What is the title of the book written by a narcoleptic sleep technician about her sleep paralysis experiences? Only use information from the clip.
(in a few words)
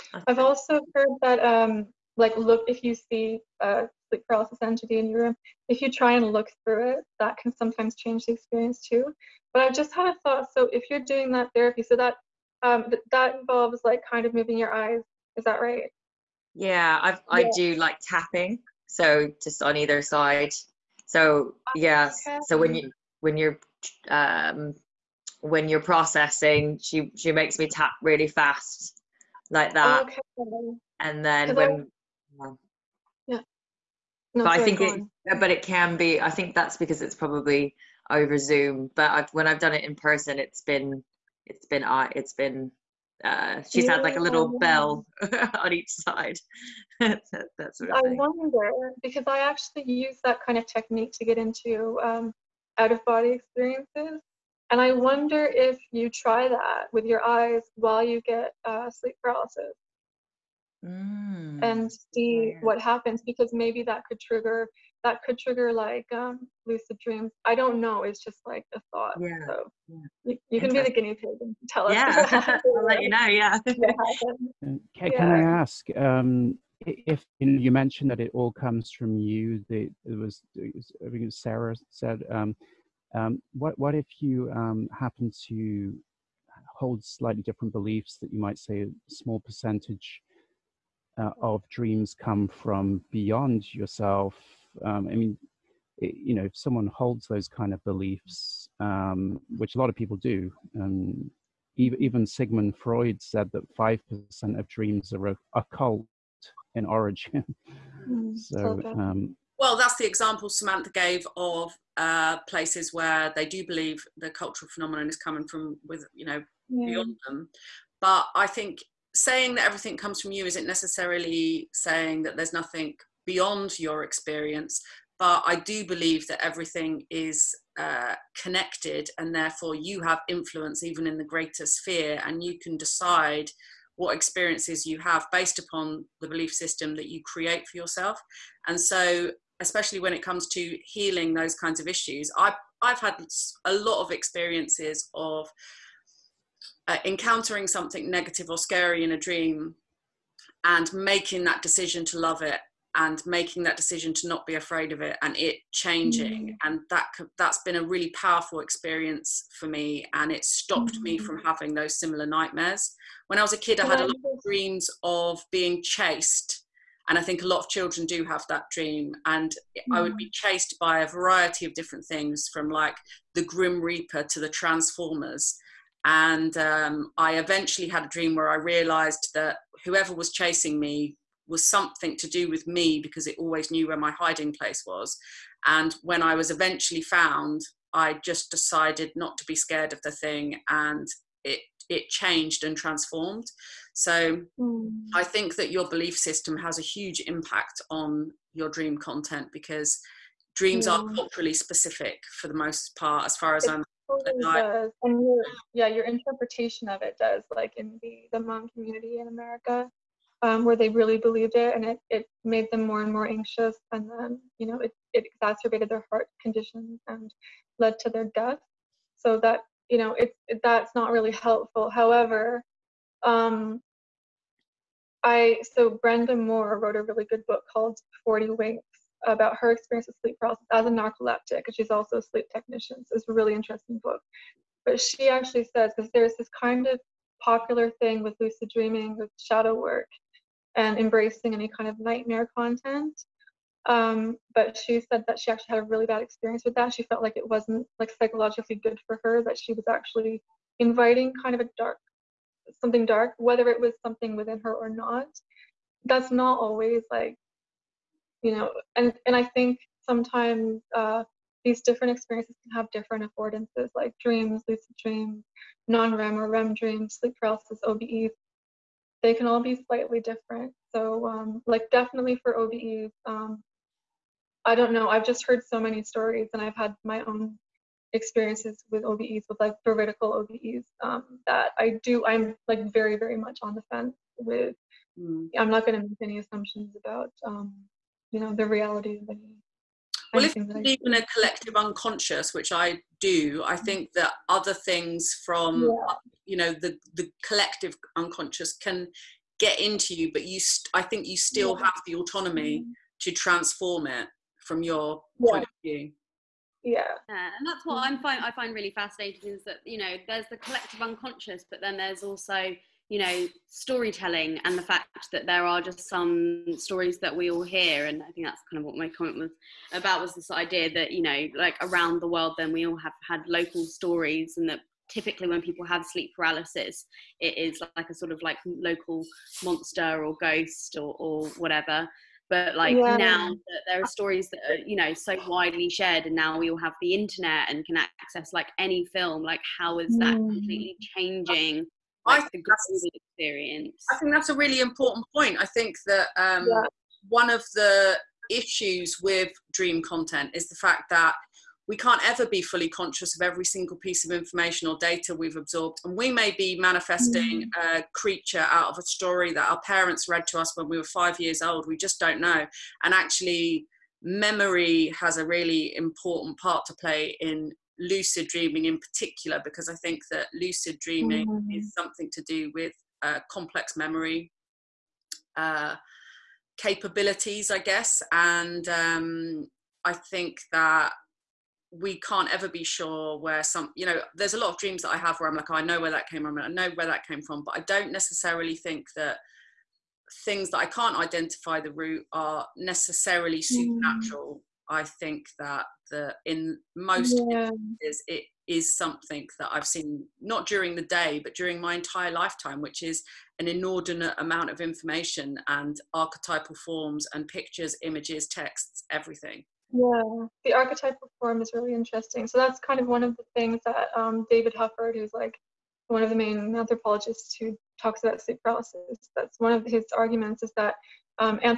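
40 Winks.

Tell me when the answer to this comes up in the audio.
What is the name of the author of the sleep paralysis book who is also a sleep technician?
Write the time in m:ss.
3:46.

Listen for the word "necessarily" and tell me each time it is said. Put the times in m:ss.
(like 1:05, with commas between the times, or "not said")
2:00, 6:28, 6:32.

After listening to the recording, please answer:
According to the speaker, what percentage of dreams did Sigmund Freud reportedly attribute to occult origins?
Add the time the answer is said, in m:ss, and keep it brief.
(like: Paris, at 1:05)
5%, at 1:43.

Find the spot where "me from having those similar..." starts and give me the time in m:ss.
2:41.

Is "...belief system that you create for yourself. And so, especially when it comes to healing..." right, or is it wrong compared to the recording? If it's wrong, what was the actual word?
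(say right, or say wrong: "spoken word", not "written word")
right.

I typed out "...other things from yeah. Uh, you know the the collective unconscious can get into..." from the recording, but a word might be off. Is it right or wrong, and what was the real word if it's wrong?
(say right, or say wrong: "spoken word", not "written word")
right.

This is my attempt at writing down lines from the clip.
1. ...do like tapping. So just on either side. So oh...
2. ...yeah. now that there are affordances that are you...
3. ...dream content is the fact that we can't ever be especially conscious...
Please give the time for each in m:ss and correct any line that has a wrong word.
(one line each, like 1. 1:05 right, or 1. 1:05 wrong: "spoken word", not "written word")
1. 0:17 right
2. 5:32 wrong: "stories", not "affordances"
3. 5:49 wrong: "fully", not "especially".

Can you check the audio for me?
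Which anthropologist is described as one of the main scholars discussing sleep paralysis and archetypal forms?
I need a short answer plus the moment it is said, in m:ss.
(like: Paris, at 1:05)
David Hufford, at 6:54.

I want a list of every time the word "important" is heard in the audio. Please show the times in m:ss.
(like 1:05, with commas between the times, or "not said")
5:44, 6:05.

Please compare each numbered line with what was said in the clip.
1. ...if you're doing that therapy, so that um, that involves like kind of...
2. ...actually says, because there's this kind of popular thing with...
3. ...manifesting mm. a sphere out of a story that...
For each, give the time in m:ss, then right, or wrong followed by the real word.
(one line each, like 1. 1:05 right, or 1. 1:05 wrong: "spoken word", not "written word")
1. 0:10 right
2. 3:55 right
3. 5:56 wrong: "creature", not "sphere".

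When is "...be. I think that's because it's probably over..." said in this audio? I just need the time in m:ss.
0:35.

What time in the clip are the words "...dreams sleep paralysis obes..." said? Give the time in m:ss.
4:26.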